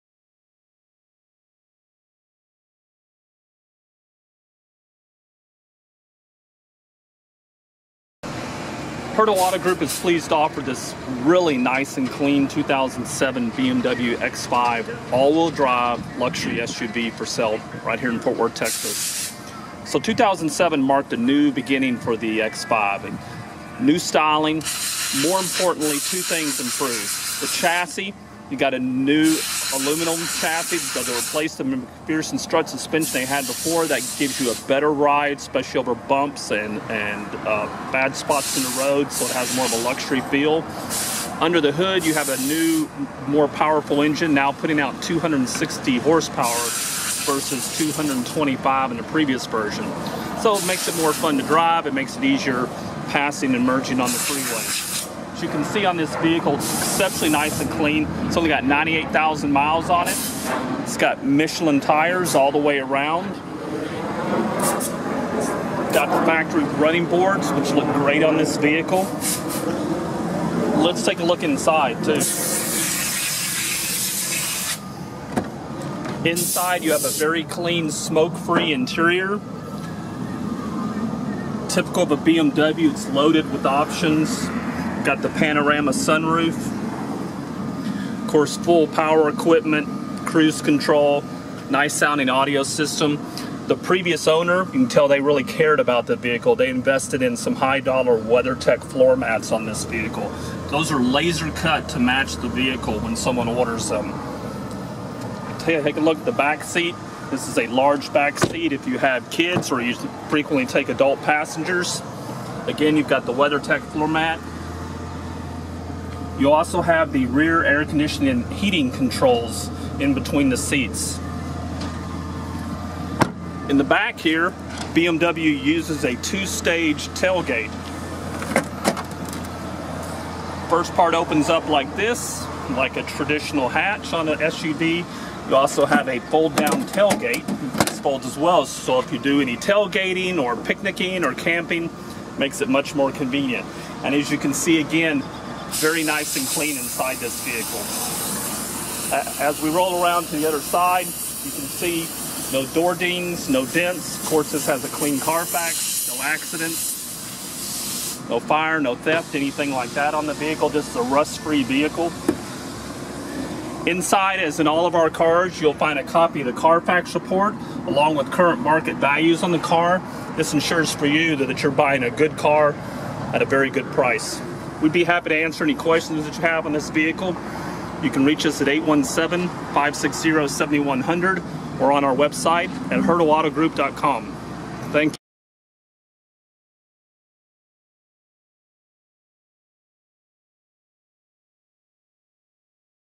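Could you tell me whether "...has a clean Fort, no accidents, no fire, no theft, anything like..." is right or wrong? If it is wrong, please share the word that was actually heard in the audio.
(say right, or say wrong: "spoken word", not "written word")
wrong: "Carfax", not "Fort".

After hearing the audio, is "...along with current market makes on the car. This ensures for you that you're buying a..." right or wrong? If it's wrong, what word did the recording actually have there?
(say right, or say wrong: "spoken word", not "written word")
wrong: "values", not "makes".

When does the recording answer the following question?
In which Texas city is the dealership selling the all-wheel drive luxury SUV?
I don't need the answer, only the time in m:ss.
0:18.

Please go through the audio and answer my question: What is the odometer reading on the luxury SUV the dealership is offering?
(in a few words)
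98,000 miles.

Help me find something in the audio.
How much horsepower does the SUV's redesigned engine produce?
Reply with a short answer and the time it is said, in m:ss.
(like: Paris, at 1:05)
260, at 0:45.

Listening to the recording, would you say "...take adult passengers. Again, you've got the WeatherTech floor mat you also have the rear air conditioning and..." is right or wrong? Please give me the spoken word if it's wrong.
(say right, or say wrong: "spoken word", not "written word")
right.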